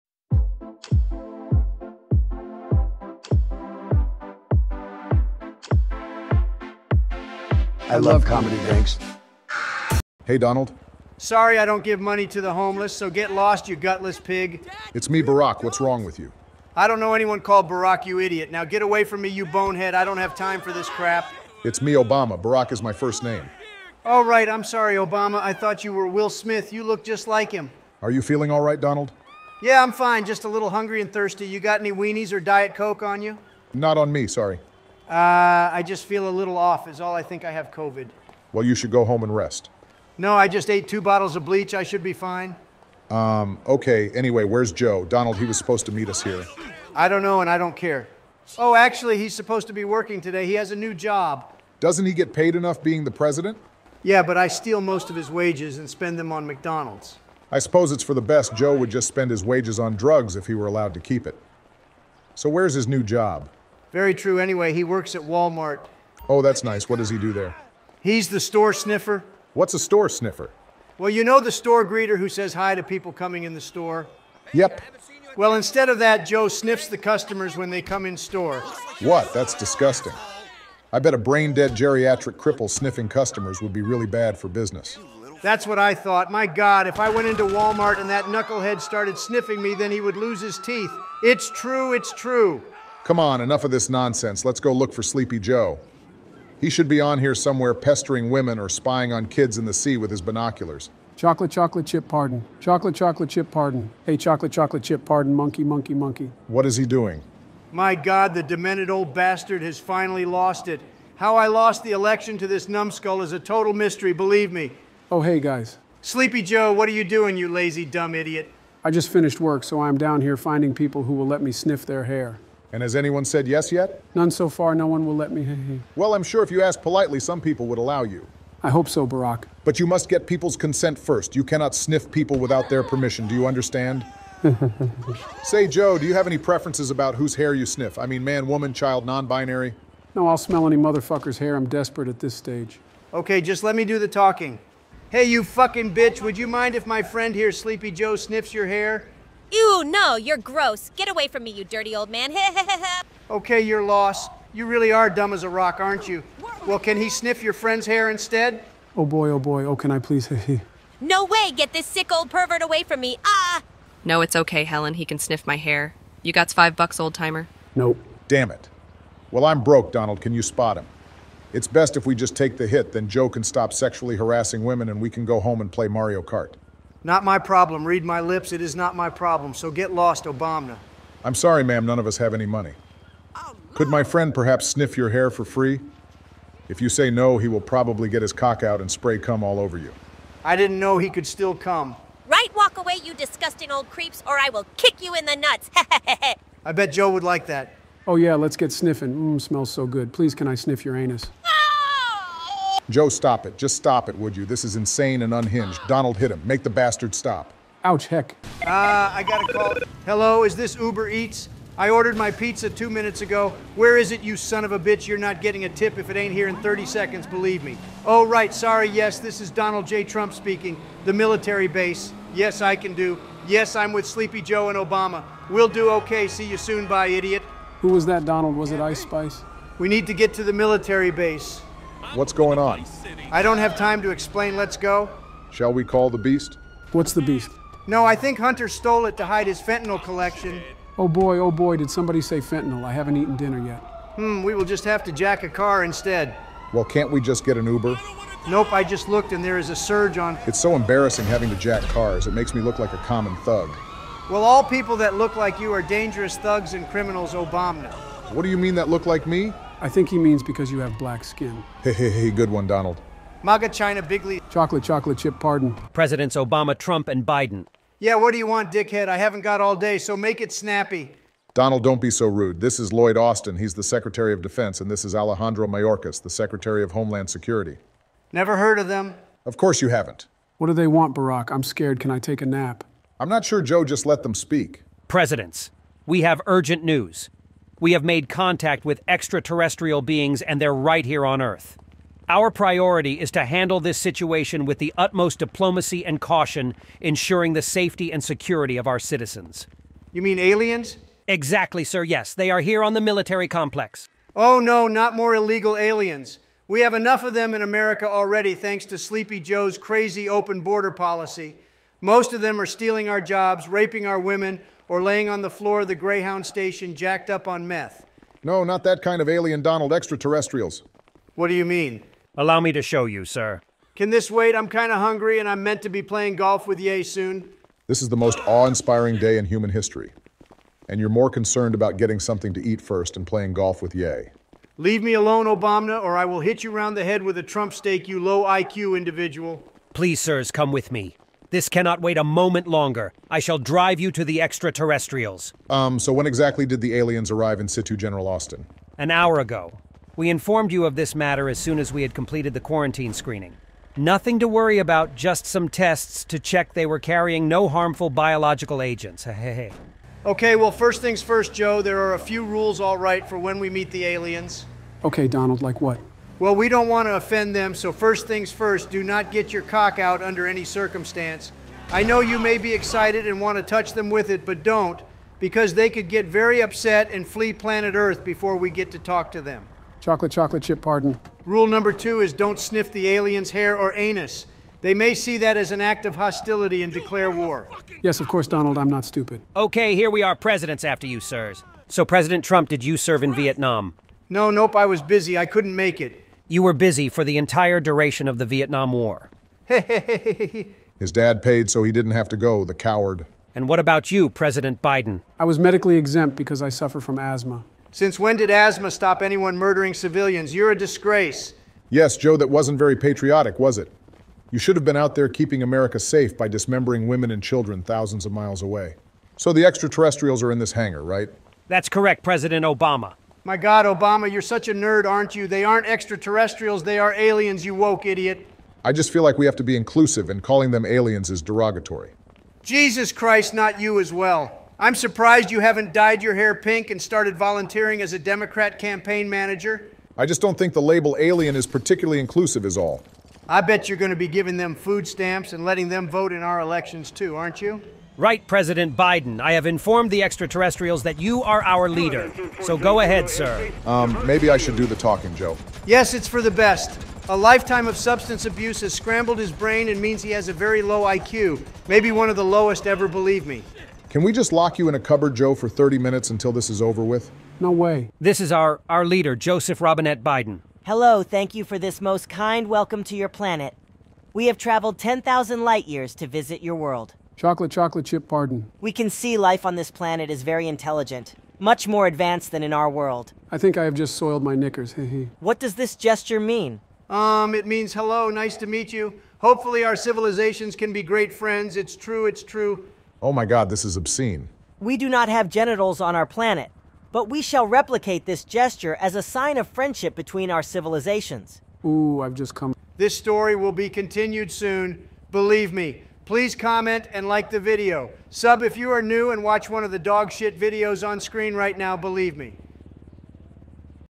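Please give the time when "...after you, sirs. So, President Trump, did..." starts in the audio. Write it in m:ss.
6:30.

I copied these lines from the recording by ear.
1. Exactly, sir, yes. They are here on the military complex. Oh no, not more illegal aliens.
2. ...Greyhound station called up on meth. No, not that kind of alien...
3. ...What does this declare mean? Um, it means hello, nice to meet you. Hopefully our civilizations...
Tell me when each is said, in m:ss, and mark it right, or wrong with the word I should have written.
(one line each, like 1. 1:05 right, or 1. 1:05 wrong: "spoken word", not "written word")
1. 5:01 right
2. 5:15 wrong: "jacked", not "called"
3. 8:05 wrong: "gesture", not "declare".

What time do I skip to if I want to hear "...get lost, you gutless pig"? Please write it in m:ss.
0:13.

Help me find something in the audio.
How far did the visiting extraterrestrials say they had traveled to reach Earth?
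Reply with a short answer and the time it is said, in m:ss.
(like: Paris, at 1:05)
10,000 light years, at 7:54.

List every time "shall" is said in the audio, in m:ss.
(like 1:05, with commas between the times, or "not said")
3:55, 5:43, 8:17.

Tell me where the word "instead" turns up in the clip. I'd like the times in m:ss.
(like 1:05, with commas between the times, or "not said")
1:15, 2:38, 4:05.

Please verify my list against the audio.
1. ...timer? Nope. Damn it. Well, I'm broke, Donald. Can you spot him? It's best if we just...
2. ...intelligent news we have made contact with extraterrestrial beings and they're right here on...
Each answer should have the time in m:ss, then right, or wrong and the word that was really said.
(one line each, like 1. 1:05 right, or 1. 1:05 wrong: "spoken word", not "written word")
1. 2:47 right
2. 4:46 wrong: "urgent", not "intelligent".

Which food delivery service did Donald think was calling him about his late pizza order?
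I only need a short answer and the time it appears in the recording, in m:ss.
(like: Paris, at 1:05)
Uber Eats, at 3:30.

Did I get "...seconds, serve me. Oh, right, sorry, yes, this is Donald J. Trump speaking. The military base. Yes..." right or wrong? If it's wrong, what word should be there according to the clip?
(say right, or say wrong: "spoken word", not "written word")
wrong: "believe", not "serve".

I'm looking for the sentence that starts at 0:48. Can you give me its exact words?
Oh, actually, he's supposed to be working today.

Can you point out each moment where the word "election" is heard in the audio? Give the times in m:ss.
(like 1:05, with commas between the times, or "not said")
1:51, 7:26.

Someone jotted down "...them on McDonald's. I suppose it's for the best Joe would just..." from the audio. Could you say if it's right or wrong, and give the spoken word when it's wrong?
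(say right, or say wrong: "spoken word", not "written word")
right.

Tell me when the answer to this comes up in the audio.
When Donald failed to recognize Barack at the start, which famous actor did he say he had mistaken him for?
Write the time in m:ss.
0:26.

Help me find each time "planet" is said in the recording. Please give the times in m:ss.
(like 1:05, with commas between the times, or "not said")
6:17, 7:53, 7:59, 8:16.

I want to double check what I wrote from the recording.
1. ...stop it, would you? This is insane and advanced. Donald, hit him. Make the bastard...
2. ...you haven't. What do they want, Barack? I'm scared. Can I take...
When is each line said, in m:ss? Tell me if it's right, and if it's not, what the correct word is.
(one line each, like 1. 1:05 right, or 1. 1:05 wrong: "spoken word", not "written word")
1. 3:23 wrong: "unhinged", not "advanced"
2. 4:39 right.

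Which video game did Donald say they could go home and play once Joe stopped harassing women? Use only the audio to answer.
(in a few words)
Mario Kart.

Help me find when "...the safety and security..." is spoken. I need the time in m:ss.
4:57.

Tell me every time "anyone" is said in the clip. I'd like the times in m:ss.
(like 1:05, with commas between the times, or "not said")
0:17, 2:02, 6:49.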